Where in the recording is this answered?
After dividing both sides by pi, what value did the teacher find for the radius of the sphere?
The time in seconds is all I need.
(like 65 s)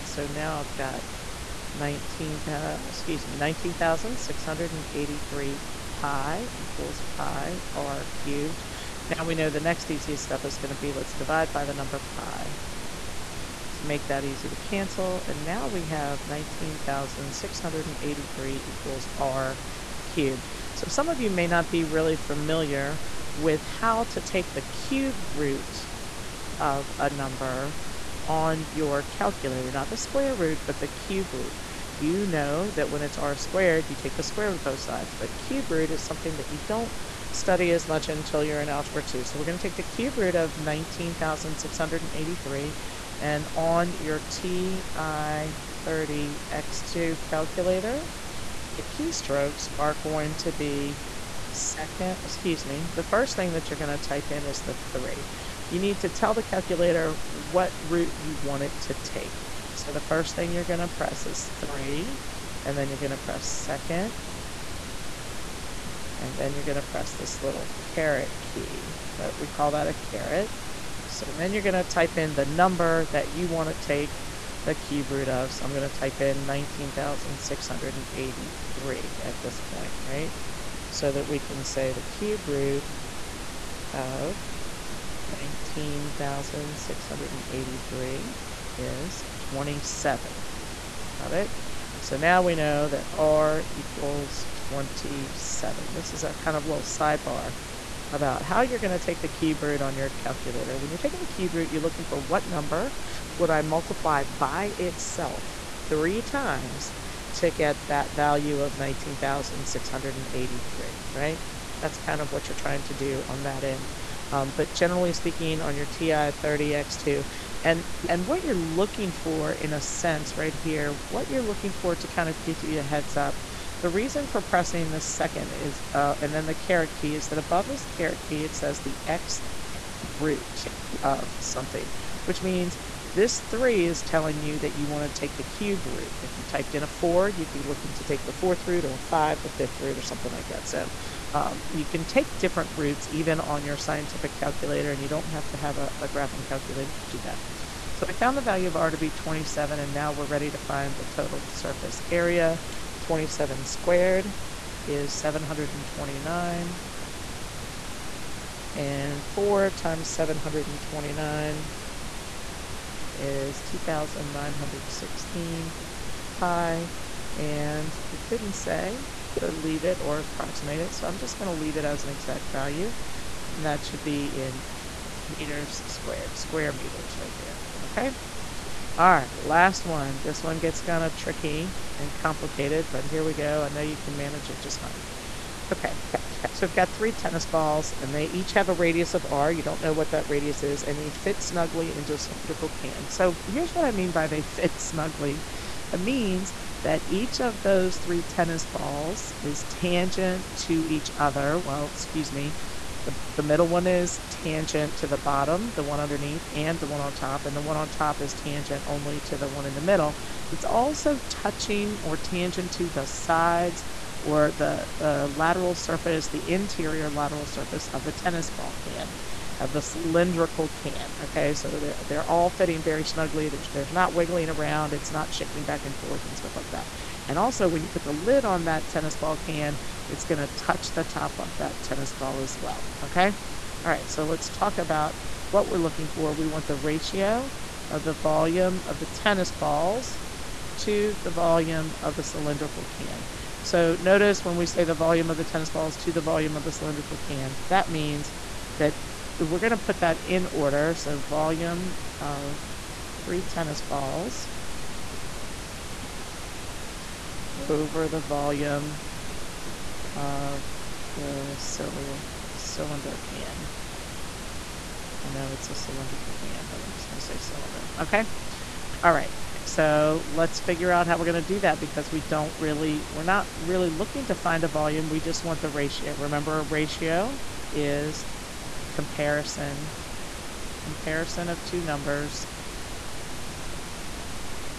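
93 s.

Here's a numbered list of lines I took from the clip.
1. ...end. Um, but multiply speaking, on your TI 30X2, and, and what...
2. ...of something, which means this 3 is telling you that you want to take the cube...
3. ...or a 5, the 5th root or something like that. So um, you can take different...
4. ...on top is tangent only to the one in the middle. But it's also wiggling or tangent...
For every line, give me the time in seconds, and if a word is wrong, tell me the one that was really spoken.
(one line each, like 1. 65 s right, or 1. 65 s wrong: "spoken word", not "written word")
1. 113 s wrong: "generally", not "multiply"
2. 131 s right
3. 138 s right
4. 207 s wrong: "touching", not "wiggling".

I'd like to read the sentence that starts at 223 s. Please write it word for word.
There's, there's not wiggling around, it's not shaking back and forth and stuff like that.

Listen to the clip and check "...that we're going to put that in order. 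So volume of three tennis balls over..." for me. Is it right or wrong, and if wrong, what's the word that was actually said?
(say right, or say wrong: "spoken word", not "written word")
right.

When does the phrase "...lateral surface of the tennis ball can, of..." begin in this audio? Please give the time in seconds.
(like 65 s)
217 s.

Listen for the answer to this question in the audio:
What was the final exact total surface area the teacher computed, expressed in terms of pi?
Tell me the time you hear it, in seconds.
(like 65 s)
163 s.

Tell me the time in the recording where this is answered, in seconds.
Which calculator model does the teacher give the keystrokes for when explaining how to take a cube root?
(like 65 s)
44 s.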